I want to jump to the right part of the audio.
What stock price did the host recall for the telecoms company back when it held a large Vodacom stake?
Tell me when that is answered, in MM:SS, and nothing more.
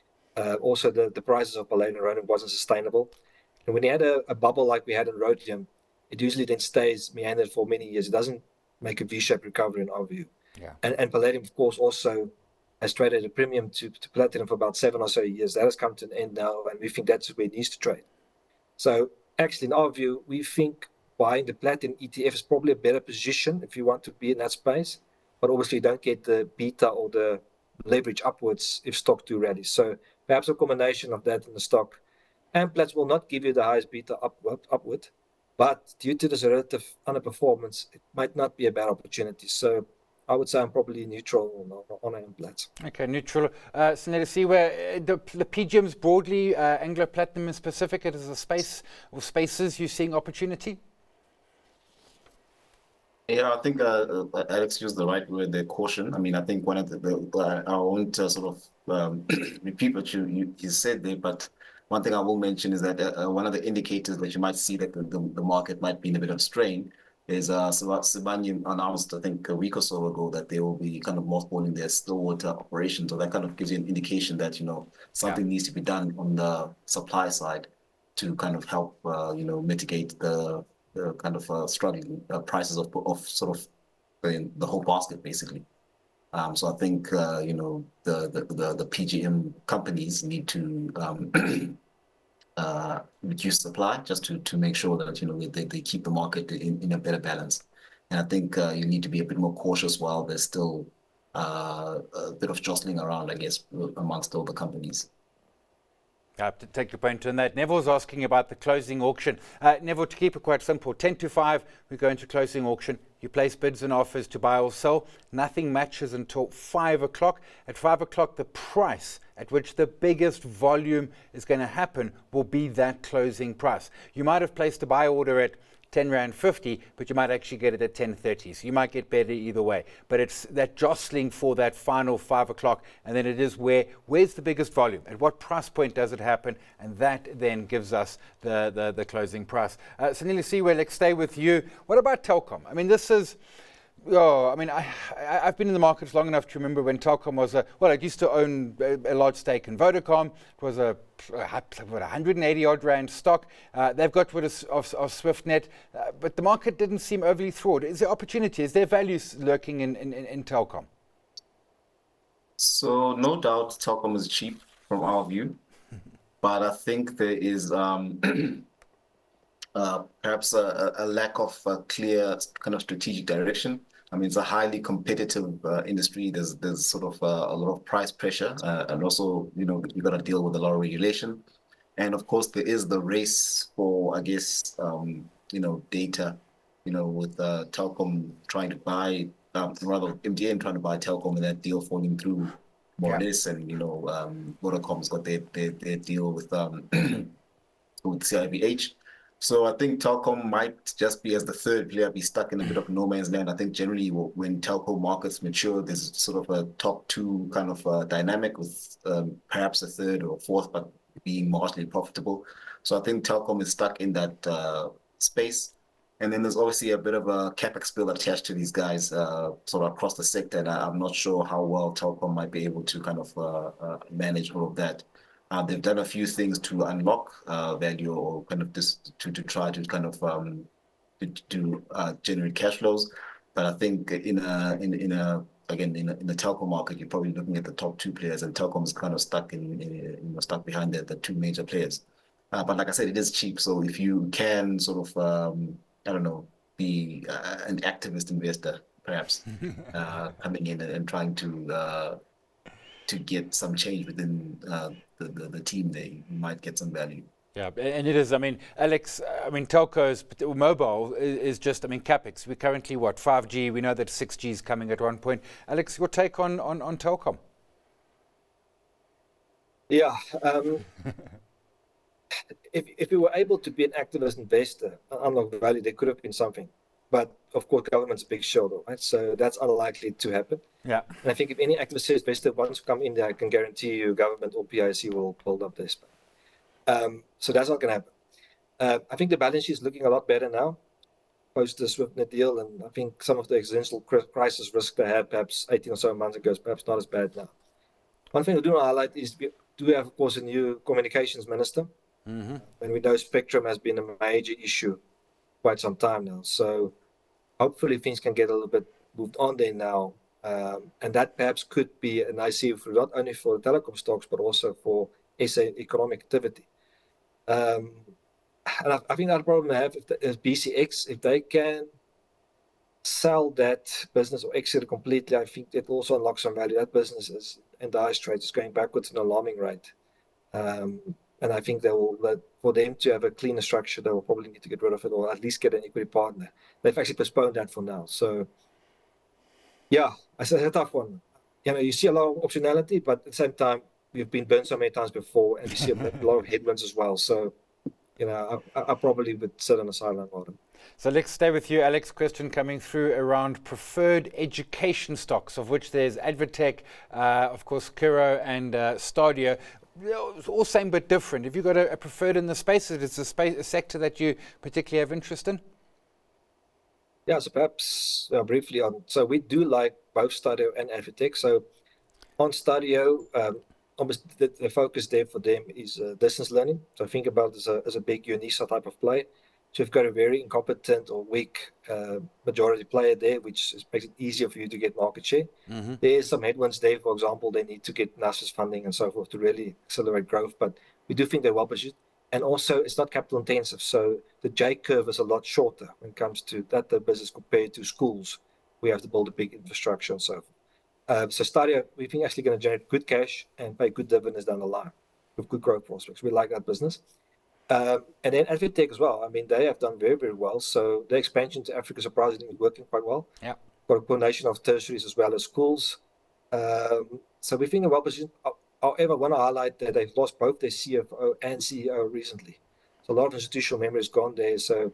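02:31.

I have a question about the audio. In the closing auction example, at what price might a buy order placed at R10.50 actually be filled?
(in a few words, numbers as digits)
10.30.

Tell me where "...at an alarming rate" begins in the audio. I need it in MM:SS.
05:29.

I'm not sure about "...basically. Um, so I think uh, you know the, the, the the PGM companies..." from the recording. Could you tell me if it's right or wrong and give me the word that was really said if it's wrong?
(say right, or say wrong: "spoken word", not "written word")
right.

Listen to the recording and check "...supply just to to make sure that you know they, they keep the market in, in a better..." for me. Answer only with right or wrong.
right.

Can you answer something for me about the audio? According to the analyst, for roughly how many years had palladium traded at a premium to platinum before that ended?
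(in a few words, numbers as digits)
7.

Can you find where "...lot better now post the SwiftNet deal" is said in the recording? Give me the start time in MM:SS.
04:50.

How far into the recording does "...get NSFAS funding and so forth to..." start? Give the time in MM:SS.
06:27.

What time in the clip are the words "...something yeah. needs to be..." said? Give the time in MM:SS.
01:15.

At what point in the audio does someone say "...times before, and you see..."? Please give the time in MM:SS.
05:44.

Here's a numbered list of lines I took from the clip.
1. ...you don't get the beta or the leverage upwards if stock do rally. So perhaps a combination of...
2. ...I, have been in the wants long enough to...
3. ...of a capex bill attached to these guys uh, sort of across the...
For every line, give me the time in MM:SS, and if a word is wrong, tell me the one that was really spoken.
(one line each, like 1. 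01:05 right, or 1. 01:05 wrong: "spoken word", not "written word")
1. 00:25 right
2. 02:25 wrong: "markets", not "wants"
3. 03:37 right.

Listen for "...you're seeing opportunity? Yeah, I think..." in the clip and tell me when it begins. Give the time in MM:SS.
00:49.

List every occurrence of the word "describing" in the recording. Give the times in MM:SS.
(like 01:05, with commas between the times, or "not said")
not said.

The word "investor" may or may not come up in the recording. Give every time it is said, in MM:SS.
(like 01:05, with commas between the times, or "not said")
04:08, 04:34.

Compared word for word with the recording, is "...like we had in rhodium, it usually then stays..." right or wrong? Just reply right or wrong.
right.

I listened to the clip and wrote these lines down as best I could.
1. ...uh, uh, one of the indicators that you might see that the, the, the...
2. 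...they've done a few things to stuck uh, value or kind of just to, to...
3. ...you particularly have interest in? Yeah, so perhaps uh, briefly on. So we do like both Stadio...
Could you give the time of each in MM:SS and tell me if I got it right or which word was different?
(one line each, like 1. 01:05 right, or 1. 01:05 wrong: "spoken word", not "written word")
1. 01:02 right
2. 03:45 wrong: "unlock", not "stuck"
3. 06:04 right.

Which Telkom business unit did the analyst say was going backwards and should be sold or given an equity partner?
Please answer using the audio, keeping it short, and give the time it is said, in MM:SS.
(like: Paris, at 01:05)
BCX, at 05:20.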